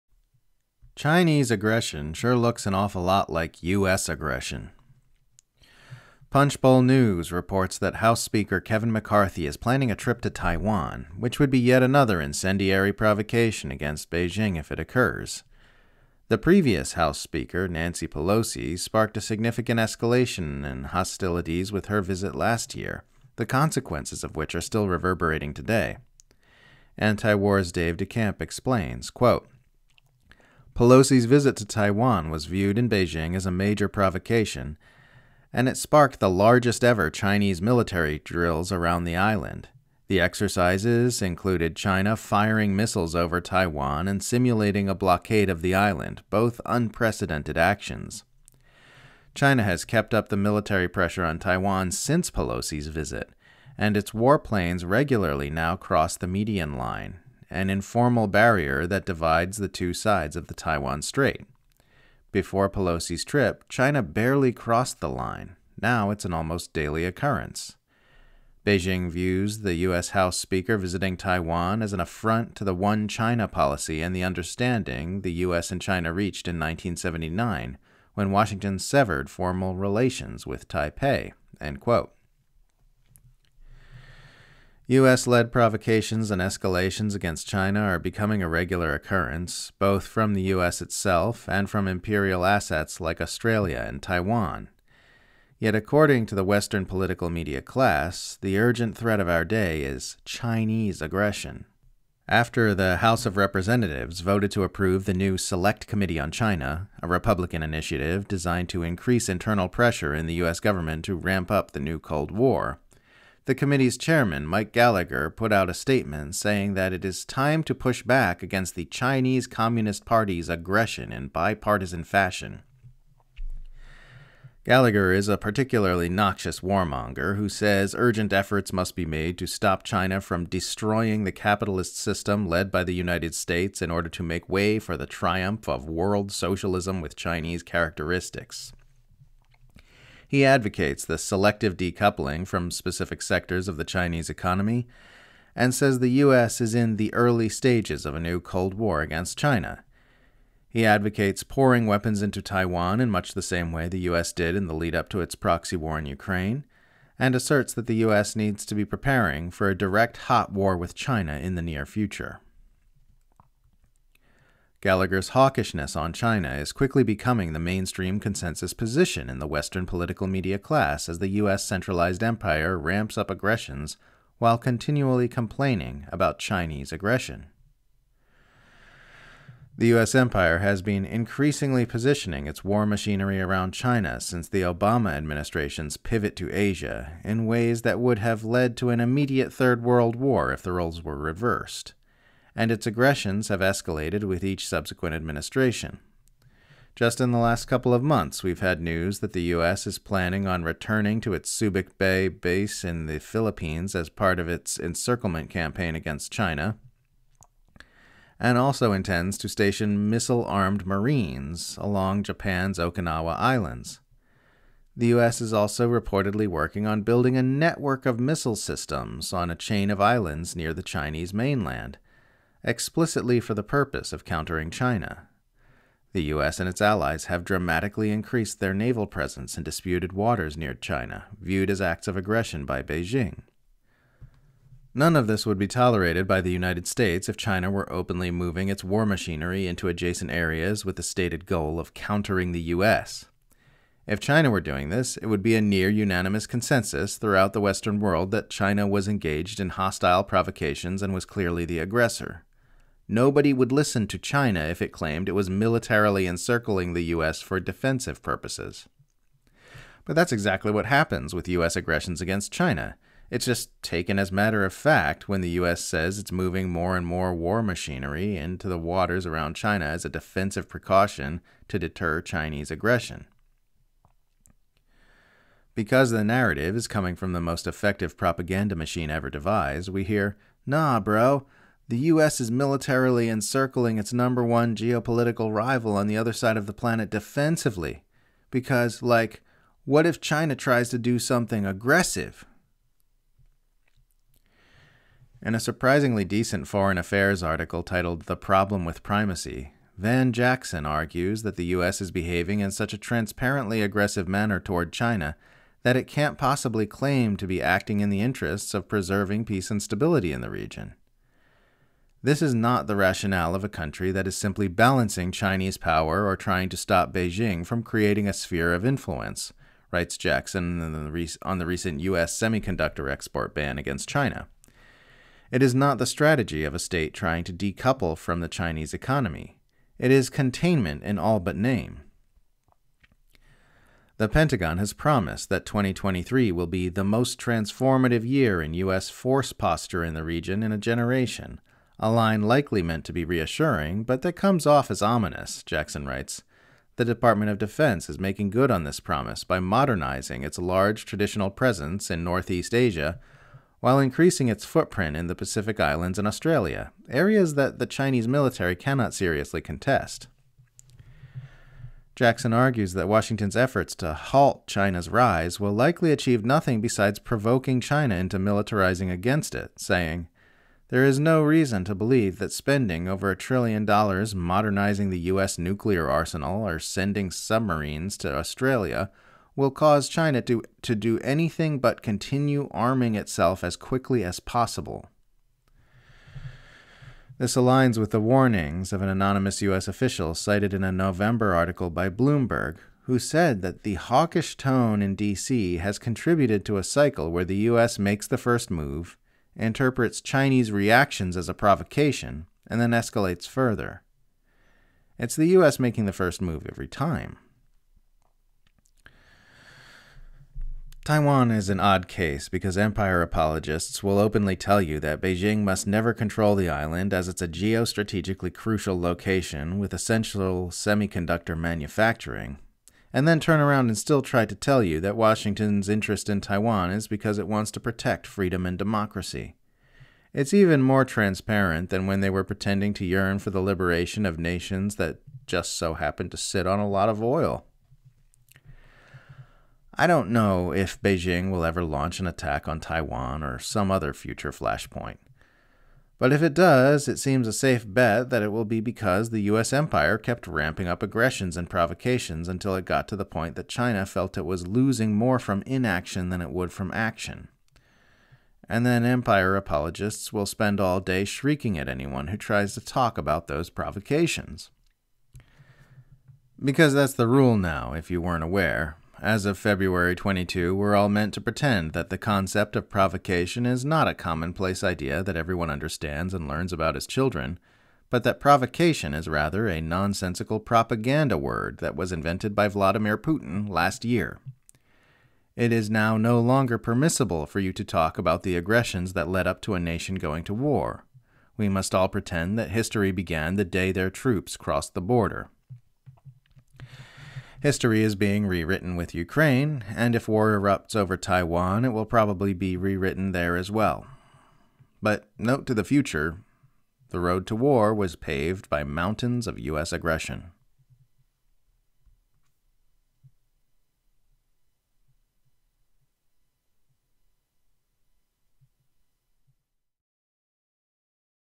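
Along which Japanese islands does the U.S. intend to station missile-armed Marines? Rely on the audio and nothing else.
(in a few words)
Okinawa Islands.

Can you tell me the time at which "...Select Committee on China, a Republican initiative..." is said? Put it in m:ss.
1:45.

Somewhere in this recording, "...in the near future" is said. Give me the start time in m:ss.
2:41.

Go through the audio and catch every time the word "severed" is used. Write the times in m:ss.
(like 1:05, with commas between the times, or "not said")
1:18.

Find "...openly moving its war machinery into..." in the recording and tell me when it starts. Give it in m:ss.
3:57.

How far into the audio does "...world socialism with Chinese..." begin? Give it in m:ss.
2:15.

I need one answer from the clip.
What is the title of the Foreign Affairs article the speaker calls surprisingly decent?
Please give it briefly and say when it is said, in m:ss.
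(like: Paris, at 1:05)
The Problem with Primacy, at 4:58.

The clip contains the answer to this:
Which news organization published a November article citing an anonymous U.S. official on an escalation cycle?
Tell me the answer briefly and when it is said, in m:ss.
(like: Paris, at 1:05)
Bloomberg, at 6:32.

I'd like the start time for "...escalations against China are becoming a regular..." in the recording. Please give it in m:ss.
1:26.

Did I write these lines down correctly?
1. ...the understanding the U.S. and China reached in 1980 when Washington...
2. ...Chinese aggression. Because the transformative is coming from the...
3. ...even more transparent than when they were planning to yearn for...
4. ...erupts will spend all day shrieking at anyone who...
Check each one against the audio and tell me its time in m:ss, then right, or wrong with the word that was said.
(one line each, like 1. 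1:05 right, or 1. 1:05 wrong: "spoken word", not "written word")
1. 1:14 wrong: "1979", not "1980"
2. 4:32 wrong: "narrative", not "transformative"
3. 7:10 wrong: "pretending", not "planning"
4. 7:39 wrong: "apologists", not "erupts".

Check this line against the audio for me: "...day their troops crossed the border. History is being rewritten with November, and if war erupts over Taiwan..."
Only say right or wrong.
wrong.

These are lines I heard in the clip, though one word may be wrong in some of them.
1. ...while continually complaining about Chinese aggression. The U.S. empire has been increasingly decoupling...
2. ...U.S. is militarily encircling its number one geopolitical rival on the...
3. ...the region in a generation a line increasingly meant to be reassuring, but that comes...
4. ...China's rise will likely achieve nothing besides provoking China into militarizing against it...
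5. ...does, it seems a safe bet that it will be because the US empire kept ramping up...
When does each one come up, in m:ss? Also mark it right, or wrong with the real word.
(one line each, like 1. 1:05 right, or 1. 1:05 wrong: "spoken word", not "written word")
1. 2:54 wrong: "positioning", not "decoupling"
2. 4:42 right
3. 5:40 wrong: "likely", not "increasingly"
4. 6:04 right
5. 7:26 right.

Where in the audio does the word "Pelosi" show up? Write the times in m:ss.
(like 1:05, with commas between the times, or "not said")
0:18, 0:30, 0:52, 1:02.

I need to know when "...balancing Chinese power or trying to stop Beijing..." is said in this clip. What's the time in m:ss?
5:14.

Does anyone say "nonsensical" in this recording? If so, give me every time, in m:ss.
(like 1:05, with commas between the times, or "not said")
7:59.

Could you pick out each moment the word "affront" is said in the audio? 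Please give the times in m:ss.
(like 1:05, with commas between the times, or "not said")
1:11.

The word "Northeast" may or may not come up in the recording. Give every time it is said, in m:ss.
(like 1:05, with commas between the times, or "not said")
5:52.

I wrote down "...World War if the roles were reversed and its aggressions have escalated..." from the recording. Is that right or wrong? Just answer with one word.
right.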